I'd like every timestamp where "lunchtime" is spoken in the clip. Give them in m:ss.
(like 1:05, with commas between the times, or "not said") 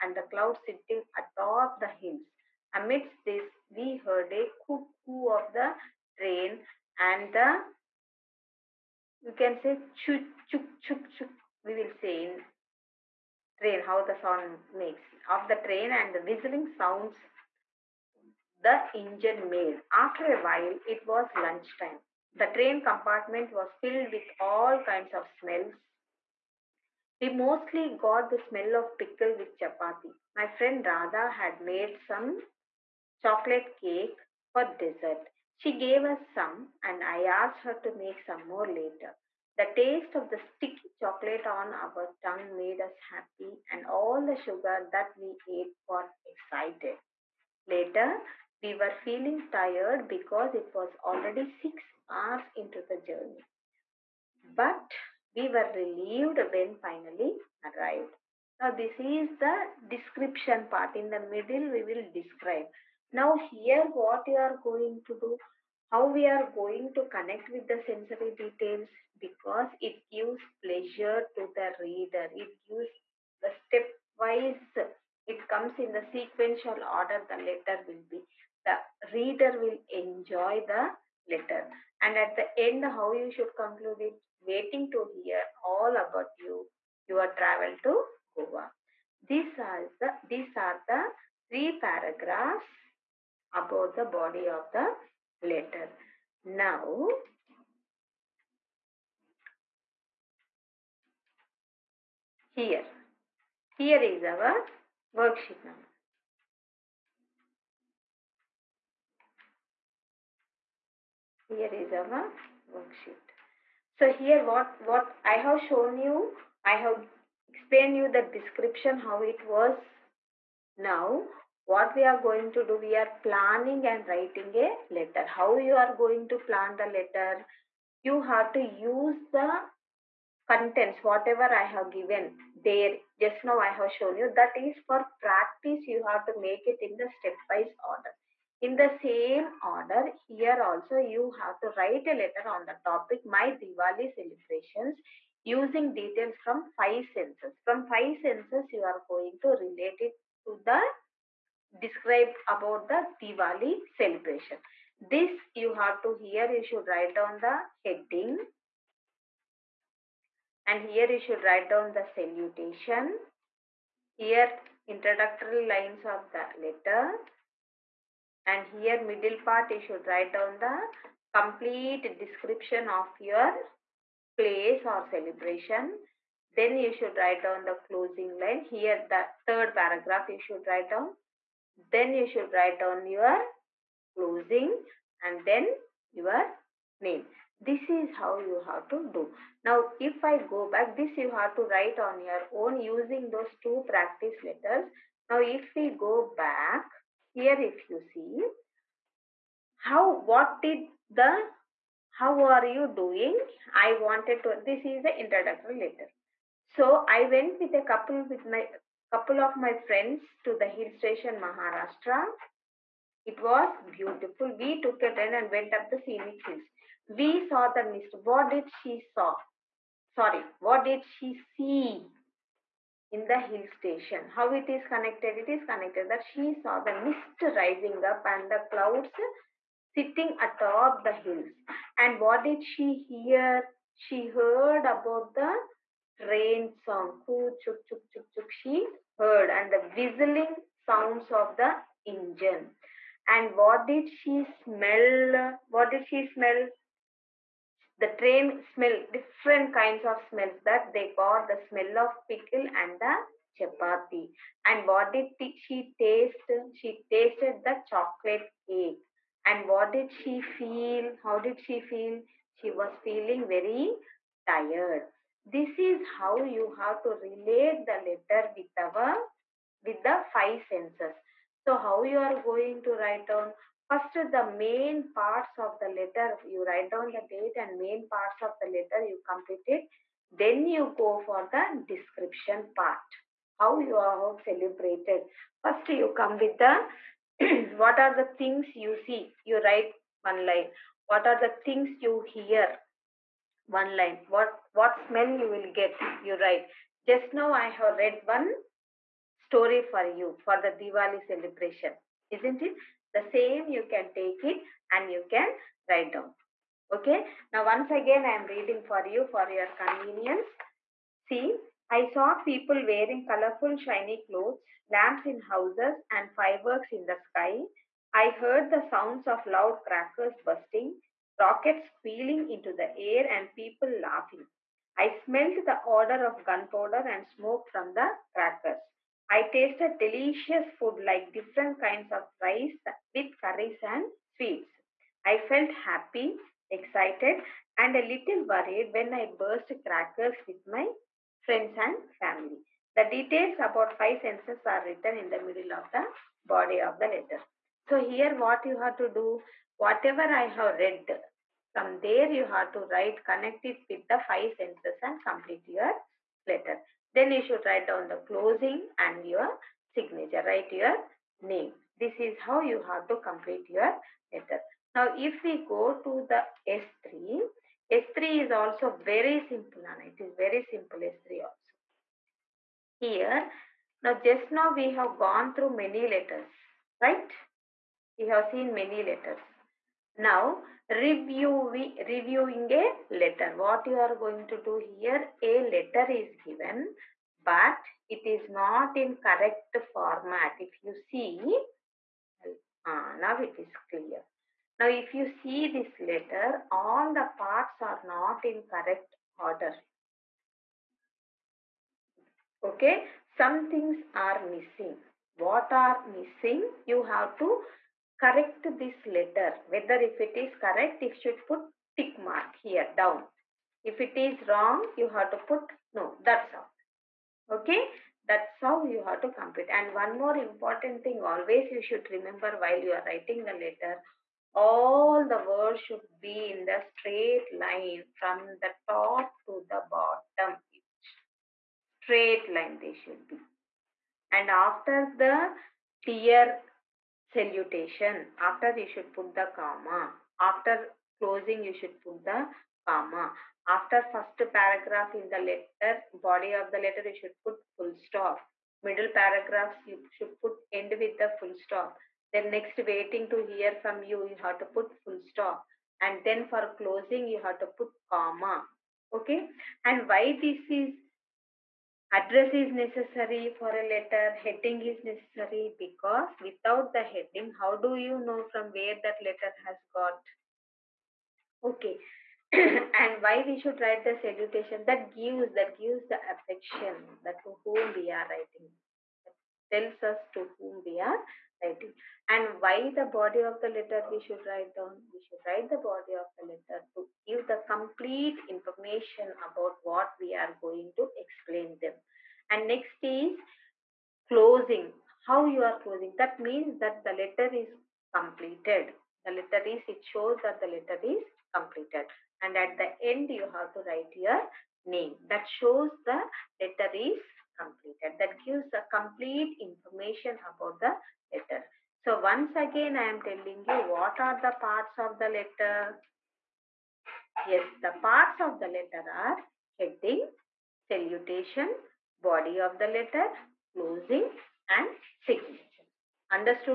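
0:21.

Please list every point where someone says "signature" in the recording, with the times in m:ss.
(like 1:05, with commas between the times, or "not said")
5:59, 8:45.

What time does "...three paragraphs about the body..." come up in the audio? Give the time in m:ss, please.
1:31.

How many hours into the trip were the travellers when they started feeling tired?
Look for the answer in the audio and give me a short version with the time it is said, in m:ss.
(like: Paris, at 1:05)
6, at 0:51.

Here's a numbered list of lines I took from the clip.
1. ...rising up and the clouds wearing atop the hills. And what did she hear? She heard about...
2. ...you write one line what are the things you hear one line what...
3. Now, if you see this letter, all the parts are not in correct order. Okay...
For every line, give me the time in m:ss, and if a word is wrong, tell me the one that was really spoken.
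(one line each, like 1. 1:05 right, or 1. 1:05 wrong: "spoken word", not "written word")
1. 3:47 wrong: "sitting", not "wearing"
2. 4:49 right
3. 6:34 right.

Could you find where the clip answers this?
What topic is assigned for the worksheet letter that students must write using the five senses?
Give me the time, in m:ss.
2:23.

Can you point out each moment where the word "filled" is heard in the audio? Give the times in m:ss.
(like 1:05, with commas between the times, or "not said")
0:23.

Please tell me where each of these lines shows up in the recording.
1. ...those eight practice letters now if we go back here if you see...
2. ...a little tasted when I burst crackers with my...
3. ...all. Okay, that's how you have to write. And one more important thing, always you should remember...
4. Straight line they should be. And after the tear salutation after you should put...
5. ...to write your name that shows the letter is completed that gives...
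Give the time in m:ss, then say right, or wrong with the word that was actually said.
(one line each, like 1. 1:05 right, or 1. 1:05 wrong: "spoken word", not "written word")
1. 3:13 wrong: "two", not "eight"
2. 5:37 wrong: "worried", not "tasted"
3. 6:56 wrong: "compute", not "write"
4. 7:11 right
5. 8:23 right.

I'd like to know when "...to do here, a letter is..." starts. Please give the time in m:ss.
6:24.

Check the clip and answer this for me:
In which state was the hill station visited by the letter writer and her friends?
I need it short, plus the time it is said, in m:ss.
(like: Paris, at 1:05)
Maharashtra, at 3:31.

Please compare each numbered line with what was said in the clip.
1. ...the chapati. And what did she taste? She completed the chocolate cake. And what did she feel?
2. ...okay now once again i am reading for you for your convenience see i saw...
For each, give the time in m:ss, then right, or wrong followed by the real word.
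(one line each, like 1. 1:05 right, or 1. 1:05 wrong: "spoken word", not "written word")
1. 4:12 wrong: "tasted", not "completed"
2. 5:06 right.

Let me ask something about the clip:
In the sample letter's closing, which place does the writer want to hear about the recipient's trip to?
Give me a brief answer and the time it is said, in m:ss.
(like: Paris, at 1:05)
Goa, at 1:28.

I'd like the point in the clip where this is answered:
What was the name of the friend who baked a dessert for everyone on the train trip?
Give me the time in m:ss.
0:30.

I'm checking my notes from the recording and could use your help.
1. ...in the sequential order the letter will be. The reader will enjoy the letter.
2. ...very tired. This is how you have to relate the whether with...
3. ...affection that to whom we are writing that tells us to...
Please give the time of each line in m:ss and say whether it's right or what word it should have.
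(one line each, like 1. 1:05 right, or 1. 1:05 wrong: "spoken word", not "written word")
1. 1:15 right
2. 4:23 wrong: "letter", not "whether"
3. 7:56 right.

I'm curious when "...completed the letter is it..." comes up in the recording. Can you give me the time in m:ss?
8:18.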